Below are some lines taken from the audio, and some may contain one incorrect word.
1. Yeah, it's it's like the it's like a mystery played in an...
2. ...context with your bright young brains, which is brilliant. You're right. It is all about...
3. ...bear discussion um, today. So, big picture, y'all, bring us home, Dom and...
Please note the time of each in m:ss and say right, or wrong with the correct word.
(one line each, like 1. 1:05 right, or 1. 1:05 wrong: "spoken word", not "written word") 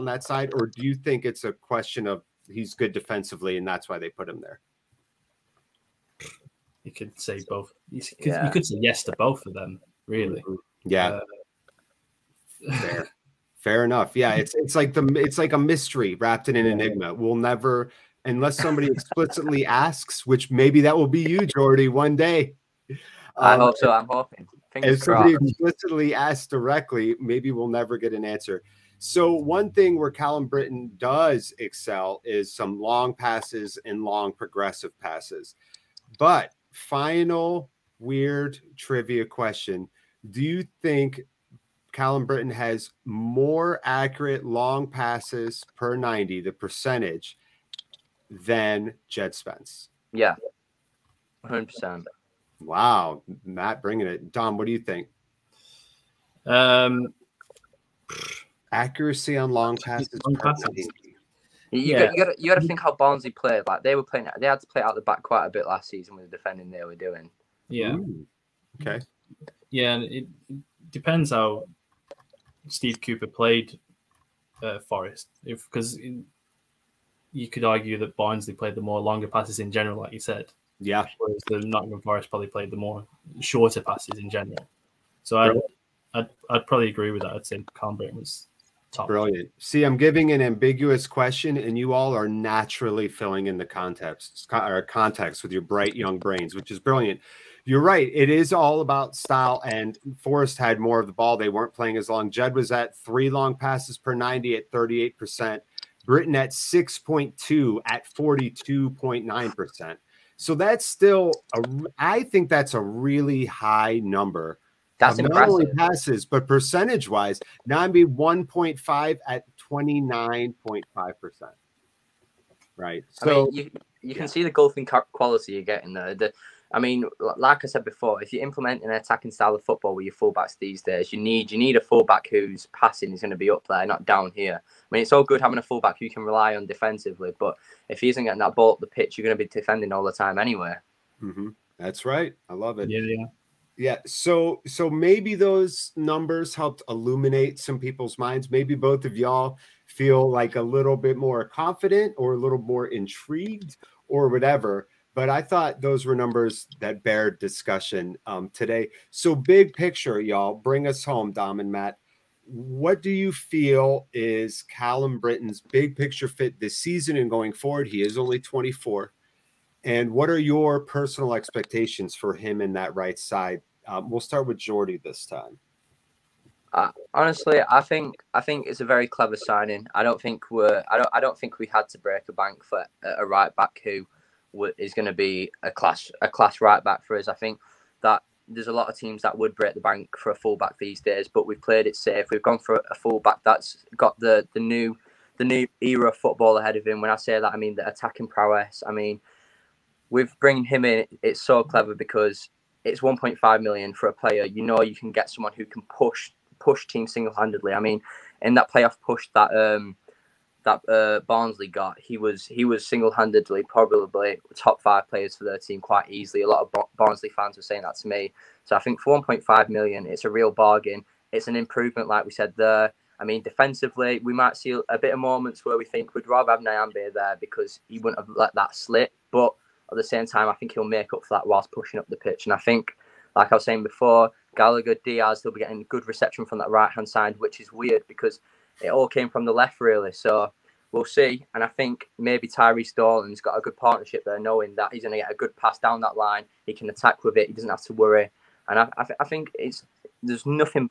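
1. 0:14 wrong: "wrapped", not "played"
2. 1:34 right
3. 2:37 right.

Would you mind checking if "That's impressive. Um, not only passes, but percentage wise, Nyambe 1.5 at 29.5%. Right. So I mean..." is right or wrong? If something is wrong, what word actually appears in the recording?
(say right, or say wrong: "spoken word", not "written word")
right.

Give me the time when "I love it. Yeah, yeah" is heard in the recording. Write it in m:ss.
2:22.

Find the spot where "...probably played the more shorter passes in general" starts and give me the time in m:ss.
1:22.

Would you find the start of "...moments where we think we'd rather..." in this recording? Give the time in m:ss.
3:45.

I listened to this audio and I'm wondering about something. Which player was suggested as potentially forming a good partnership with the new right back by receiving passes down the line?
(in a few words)
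Tyrese Stallings.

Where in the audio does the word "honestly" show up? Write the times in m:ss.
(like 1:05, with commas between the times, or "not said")
2:57.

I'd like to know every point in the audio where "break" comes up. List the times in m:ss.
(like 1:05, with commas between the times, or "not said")
3:01, 3:09.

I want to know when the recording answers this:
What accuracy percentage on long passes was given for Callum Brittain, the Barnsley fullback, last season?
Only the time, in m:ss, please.
1:48.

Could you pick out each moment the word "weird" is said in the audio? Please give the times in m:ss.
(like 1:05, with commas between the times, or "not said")
0:37, 3:57.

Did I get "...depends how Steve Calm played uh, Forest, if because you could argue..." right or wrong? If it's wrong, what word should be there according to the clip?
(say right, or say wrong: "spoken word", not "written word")
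wrong: "Cooper", not "Calm".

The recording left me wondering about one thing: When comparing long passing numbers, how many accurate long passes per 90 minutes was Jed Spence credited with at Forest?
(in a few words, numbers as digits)
3.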